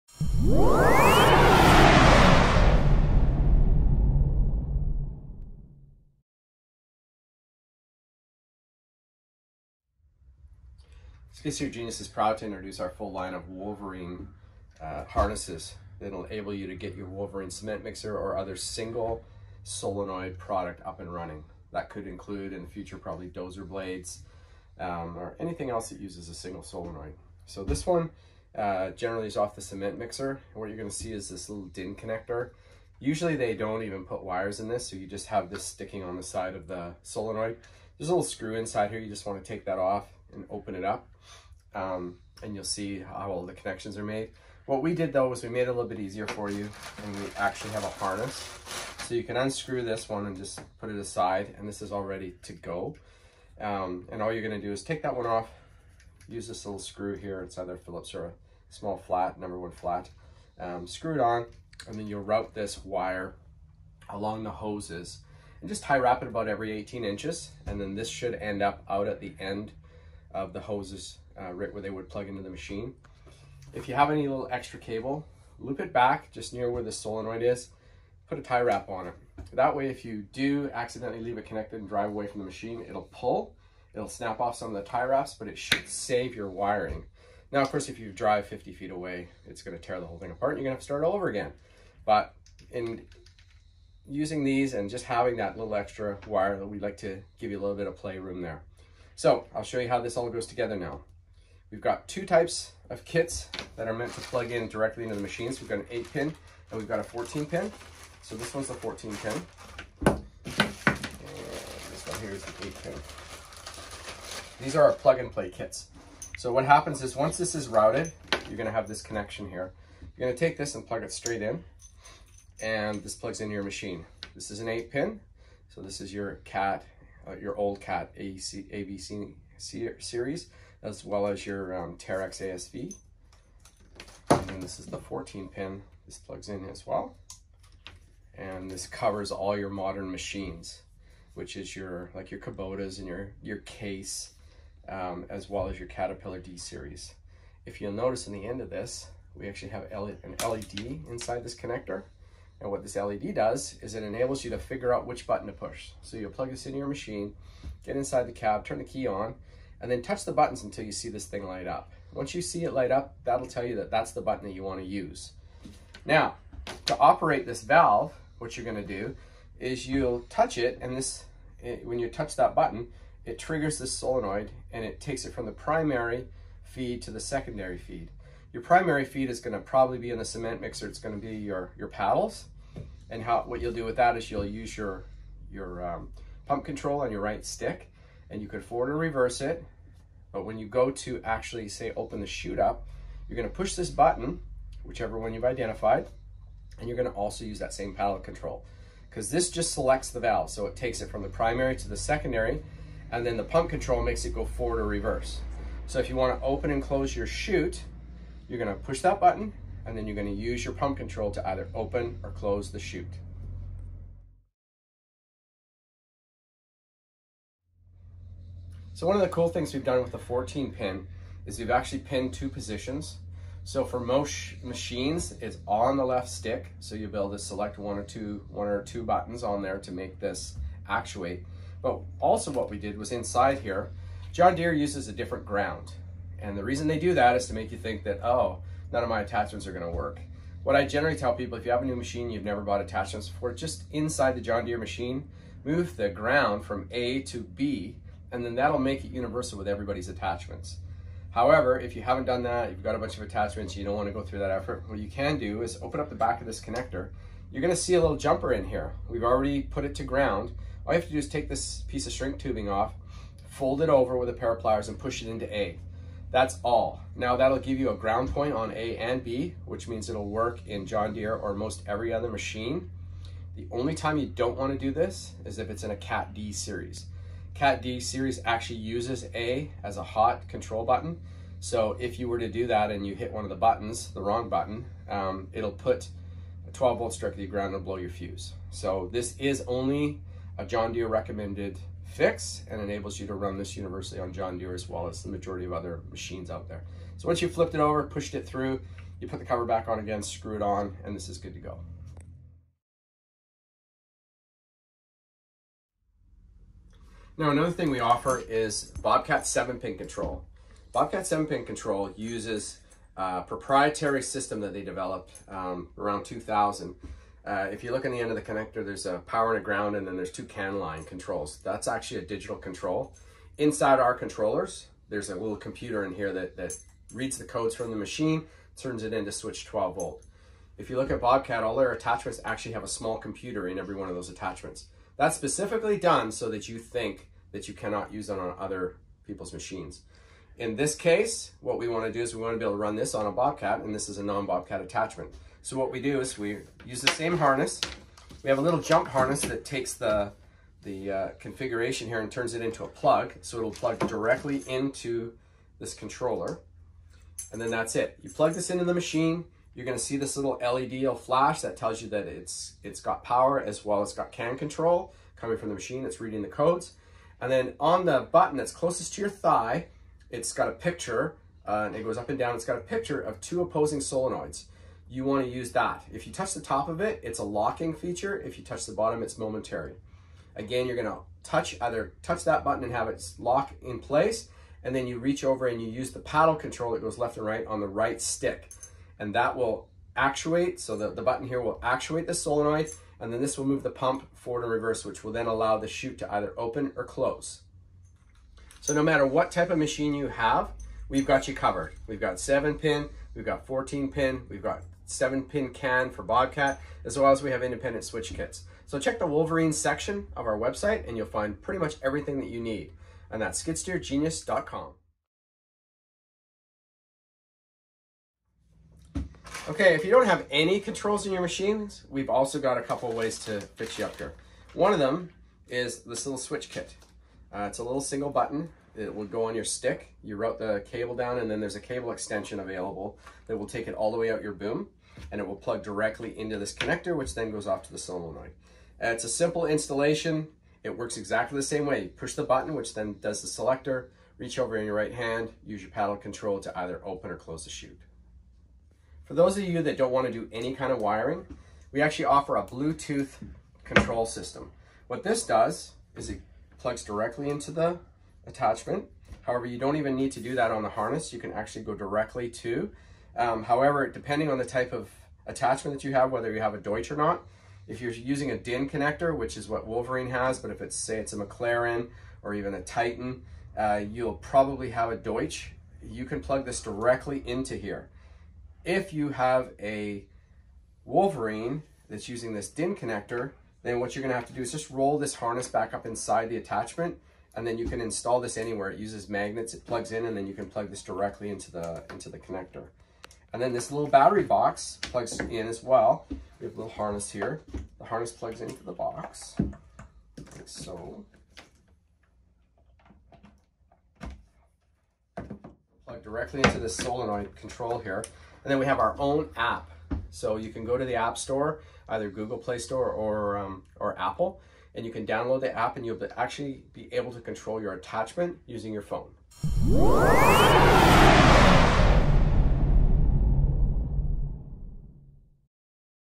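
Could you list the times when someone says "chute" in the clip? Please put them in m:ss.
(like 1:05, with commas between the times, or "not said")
3:12, 3:27, 3:32, 6:35, 7:27.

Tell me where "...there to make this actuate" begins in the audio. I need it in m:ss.
3:49.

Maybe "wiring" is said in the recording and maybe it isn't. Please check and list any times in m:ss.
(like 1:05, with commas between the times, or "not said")
1:26, 7:30.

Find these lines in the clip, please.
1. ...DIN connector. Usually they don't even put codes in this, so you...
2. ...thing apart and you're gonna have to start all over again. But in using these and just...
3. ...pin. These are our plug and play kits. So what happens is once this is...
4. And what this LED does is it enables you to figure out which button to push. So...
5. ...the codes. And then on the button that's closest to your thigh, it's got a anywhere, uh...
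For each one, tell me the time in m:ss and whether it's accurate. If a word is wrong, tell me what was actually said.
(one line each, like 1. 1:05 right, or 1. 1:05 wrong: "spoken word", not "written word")
1. 0:31 wrong: "wires", not "codes"
2. 1:30 right
3. 1:52 right
4. 2:32 right
5. 6:06 wrong: "picture", not "anywhere".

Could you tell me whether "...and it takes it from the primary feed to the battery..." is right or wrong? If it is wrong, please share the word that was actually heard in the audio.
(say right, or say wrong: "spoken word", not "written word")
wrong: "secondary", not "battery".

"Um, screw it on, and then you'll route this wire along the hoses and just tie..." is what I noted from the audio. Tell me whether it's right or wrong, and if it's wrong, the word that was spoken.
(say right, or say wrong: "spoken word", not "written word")
right.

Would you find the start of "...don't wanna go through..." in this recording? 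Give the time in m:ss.
4:13.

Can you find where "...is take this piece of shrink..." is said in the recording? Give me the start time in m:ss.
4:21.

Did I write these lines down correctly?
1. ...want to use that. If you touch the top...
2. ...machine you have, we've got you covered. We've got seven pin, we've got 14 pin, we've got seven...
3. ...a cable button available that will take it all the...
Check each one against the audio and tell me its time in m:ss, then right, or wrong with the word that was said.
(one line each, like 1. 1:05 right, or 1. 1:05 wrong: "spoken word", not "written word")
1. 6:15 right
2. 6:39 right
3. 7:11 wrong: "extension", not "button".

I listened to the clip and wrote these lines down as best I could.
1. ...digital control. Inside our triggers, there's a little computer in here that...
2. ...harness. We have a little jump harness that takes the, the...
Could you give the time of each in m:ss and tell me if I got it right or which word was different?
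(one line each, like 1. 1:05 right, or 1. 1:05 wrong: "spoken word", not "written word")
1. 5:22 wrong: "controllers", not "triggers"
2. 5:47 right.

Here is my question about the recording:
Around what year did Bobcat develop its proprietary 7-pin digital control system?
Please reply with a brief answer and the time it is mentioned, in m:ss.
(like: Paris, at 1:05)
2000, at 5:16.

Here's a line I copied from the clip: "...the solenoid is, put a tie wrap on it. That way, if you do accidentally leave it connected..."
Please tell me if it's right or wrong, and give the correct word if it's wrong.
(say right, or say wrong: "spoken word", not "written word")
right.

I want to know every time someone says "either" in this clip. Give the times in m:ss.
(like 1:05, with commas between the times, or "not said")
0:57, 3:31, 6:21, 6:36, 7:26, 8:32.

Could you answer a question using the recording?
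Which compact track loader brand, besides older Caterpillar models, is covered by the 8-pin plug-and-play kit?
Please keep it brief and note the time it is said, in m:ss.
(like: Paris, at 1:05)
Terex ASV, at 2:11.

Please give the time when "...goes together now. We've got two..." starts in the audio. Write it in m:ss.
1:40.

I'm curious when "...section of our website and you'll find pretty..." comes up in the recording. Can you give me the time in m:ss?
6:49.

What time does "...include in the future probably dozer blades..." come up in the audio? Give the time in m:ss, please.
0:22.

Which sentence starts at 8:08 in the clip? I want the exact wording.
It uses magnets, it plugs in, and then you can plug this directly into the, into the connector.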